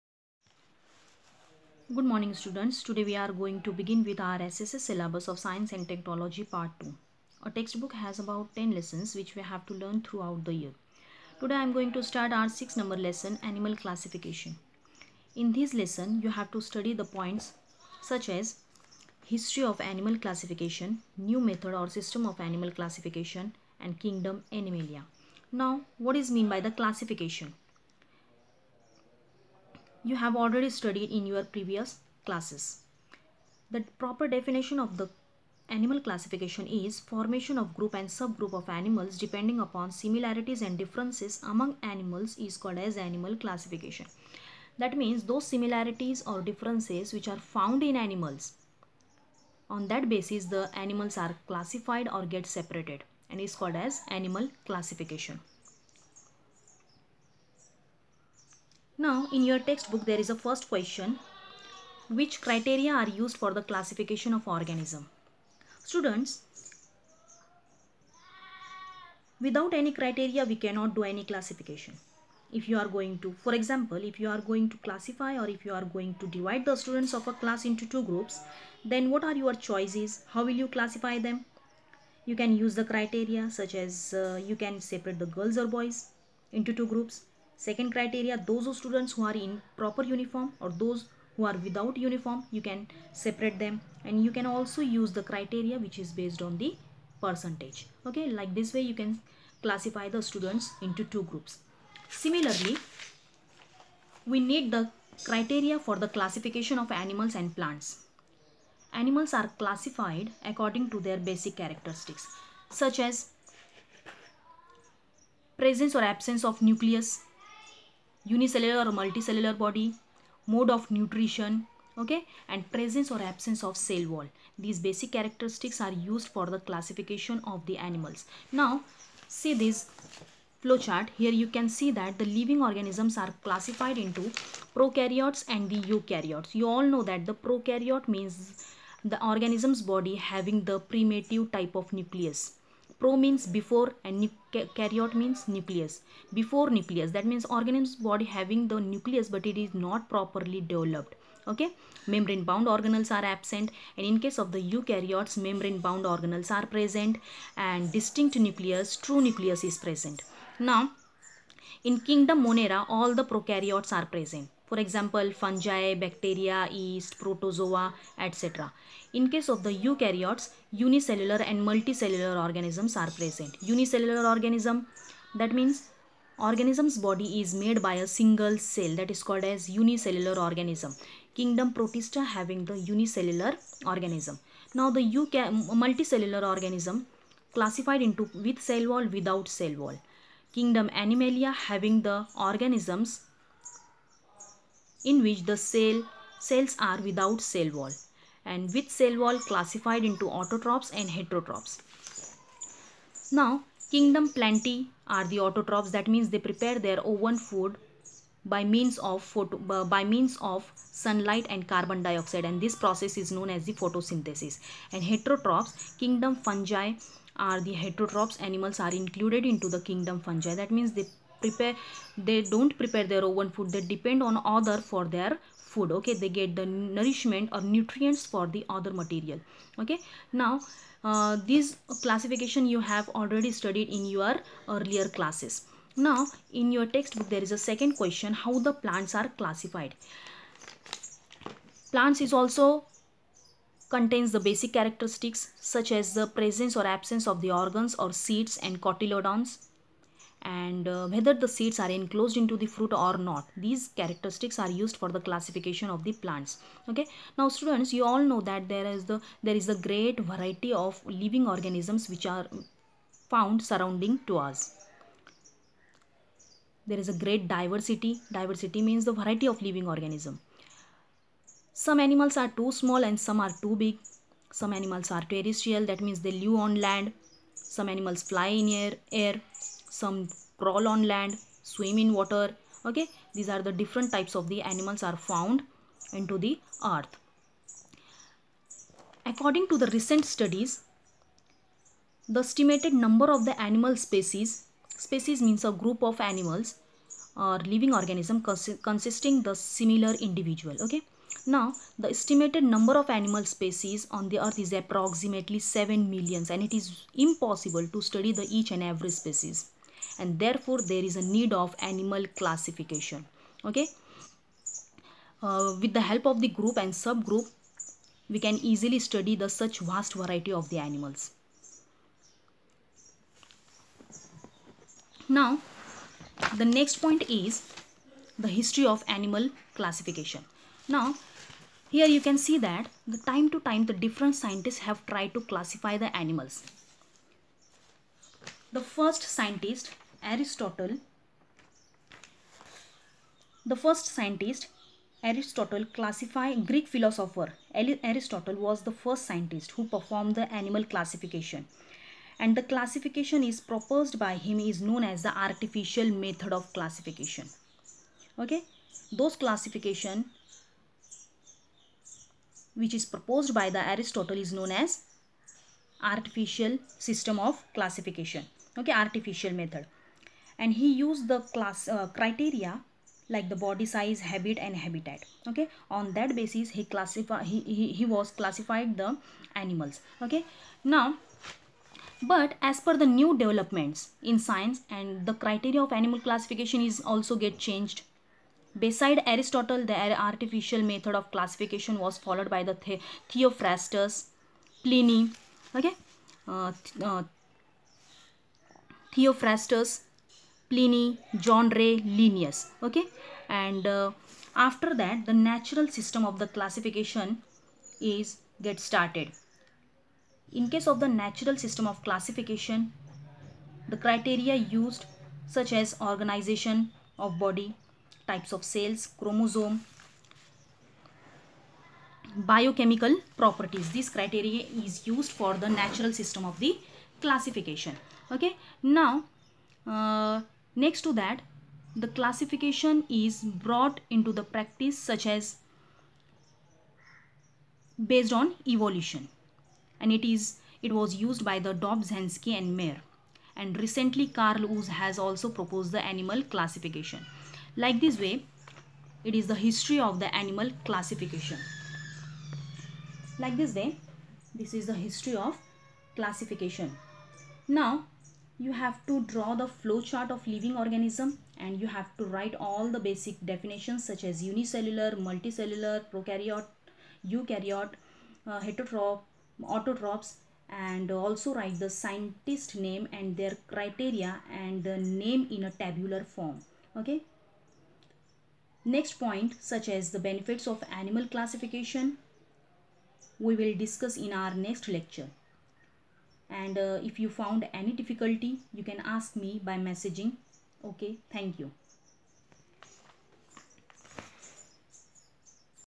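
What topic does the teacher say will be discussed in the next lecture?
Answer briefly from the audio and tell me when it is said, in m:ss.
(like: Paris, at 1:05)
Benefits of animal classification, at 8:00.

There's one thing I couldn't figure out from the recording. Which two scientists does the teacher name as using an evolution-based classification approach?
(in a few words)
Dobzhansky and Mayr.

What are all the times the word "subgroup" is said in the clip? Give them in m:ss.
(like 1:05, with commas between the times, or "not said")
0:38, 5:16.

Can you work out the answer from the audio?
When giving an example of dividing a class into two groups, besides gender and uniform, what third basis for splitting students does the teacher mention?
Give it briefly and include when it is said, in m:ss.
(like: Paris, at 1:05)
Percentage, at 1:37.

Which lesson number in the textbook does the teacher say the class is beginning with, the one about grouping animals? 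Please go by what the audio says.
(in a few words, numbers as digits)
6.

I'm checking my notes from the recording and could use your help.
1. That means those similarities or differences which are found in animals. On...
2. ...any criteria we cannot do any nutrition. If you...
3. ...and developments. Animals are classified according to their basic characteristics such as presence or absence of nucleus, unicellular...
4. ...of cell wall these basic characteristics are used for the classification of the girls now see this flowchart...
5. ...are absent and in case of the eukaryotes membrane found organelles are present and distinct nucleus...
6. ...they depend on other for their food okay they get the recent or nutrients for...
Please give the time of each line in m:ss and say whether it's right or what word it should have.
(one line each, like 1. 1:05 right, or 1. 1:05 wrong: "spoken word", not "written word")
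1. 0:44 right
2. 1:09 wrong: "classification", not "nutrition"
3. 1:47 wrong: "plants", not "developments"
4. 2:03 wrong: "animals", not "girls"
5. 2:33 wrong: "bound", not "found"
6. 3:43 wrong: "nourishment", not "recent".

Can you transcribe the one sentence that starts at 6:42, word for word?
Okay, and uh, after that, the natural system of the classification is get started.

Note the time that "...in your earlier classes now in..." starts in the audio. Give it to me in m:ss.
3:53.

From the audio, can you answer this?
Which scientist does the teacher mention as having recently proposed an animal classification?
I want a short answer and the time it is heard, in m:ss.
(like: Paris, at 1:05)
Carl Woese, at 7:24.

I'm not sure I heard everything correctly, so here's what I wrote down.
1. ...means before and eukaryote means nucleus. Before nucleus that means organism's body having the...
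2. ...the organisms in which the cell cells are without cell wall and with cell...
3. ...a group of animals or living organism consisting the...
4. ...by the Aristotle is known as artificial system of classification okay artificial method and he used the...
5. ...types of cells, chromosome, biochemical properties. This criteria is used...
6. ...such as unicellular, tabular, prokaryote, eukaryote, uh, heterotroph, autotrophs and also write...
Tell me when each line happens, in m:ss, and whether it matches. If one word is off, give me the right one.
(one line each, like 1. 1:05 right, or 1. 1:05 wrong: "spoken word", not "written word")
1. 2:23 right
2. 3:12 right
3. 4:55 right
4. 6:03 right
5. 6:58 right
6. 7:44 wrong: "multicellular", not "tabular".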